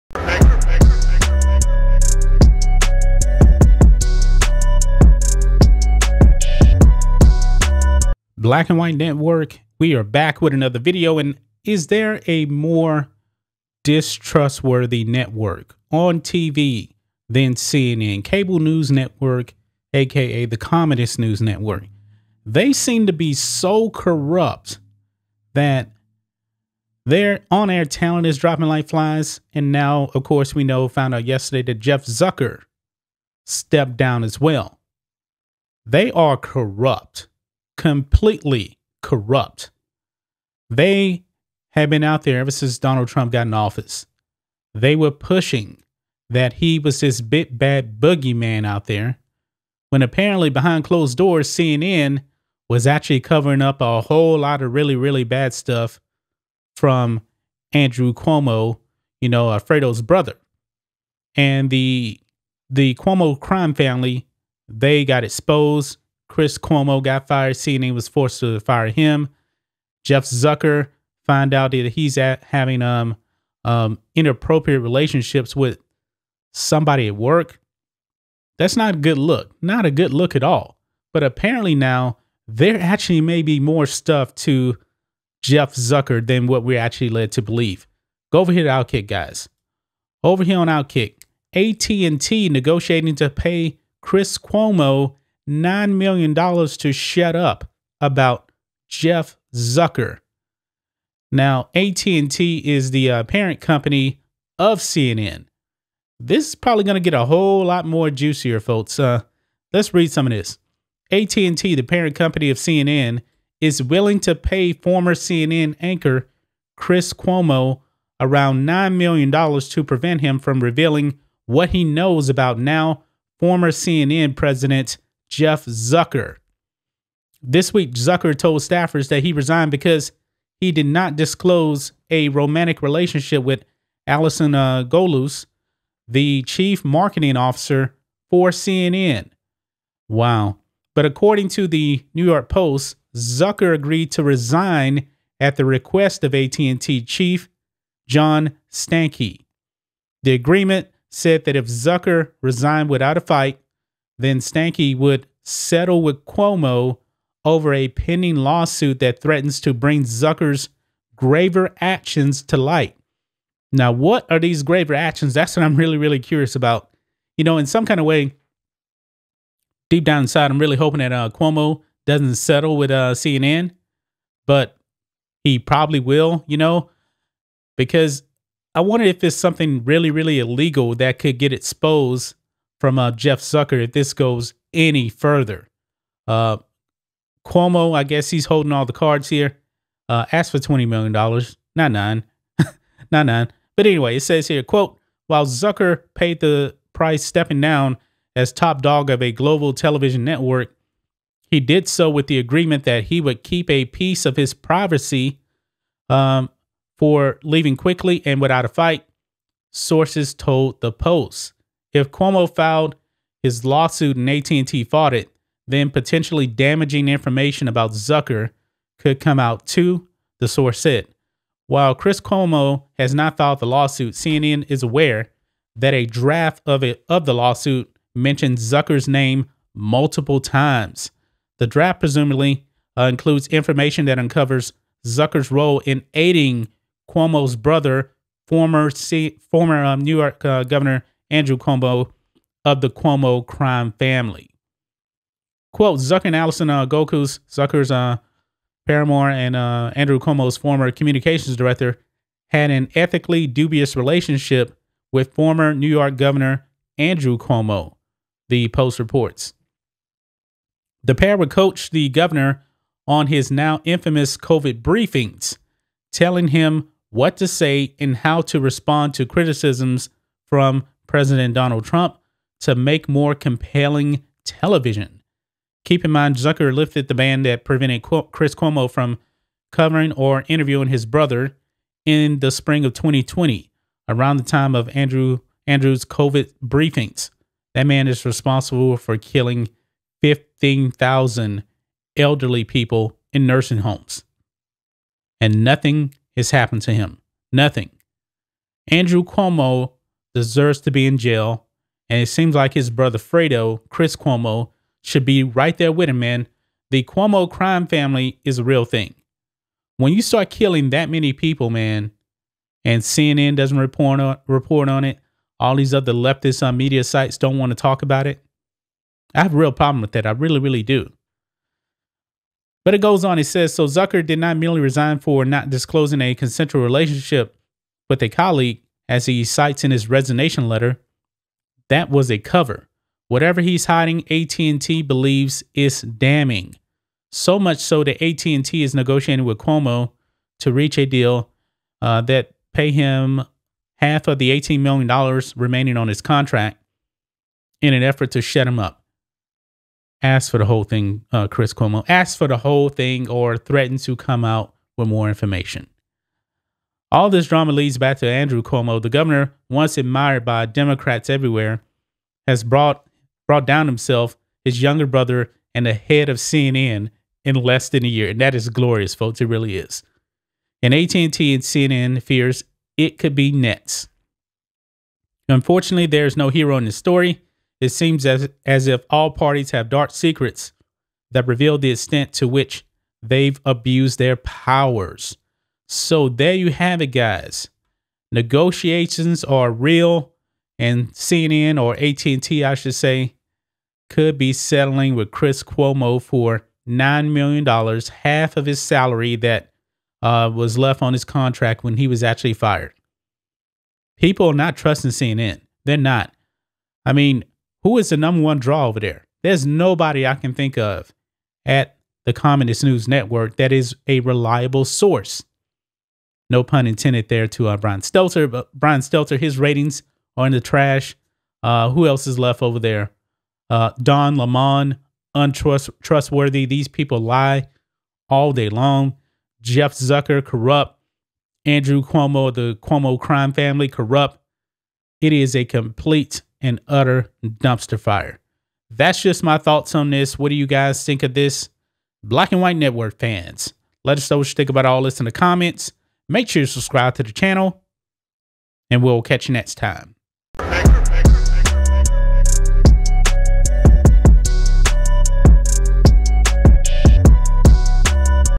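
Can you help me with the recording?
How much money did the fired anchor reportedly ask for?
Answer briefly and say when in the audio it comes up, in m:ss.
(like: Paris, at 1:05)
$20 million, at 3:10.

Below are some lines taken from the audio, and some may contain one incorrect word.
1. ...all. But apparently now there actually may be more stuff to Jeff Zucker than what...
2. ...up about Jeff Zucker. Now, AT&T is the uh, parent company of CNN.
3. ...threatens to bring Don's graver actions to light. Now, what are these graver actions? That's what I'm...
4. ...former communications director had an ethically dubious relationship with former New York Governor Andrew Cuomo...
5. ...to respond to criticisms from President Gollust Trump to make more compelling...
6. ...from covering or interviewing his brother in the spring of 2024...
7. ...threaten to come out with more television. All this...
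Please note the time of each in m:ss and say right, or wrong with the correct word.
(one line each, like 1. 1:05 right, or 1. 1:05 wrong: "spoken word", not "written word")
1. 1:20 right
2. 1:37 right
3. 2:39 wrong: "Zucker", not "Don"
4. 4:10 right
5. 4:28 wrong: "Donald", not "Gollust"
6. 4:38 wrong: "2020", not "2024"
7. 5:53 wrong: "information", not "television".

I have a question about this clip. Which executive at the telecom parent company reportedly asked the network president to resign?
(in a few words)
John Stankey.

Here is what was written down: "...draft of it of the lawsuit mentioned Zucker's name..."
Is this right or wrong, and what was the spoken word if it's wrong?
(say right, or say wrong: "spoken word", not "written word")
right.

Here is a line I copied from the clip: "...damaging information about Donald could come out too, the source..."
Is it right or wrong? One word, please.
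wrong.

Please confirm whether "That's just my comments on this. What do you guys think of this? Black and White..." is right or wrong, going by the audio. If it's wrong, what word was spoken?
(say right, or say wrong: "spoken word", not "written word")
wrong: "thoughts", not "comments".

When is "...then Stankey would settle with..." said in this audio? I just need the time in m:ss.
2:34.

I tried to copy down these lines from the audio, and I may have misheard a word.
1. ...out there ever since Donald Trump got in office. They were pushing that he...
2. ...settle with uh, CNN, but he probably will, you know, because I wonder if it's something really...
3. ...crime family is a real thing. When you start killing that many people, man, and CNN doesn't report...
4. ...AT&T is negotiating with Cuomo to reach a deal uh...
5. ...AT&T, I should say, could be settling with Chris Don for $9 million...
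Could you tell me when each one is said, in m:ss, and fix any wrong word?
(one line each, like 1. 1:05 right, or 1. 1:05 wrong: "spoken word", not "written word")
1. 0:42 right
2. 2:52 right
3. 5:07 right
4. 5:38 right
5. 6:31 wrong: "Cuomo", not "Don".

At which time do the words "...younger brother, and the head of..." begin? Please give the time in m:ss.
6:04.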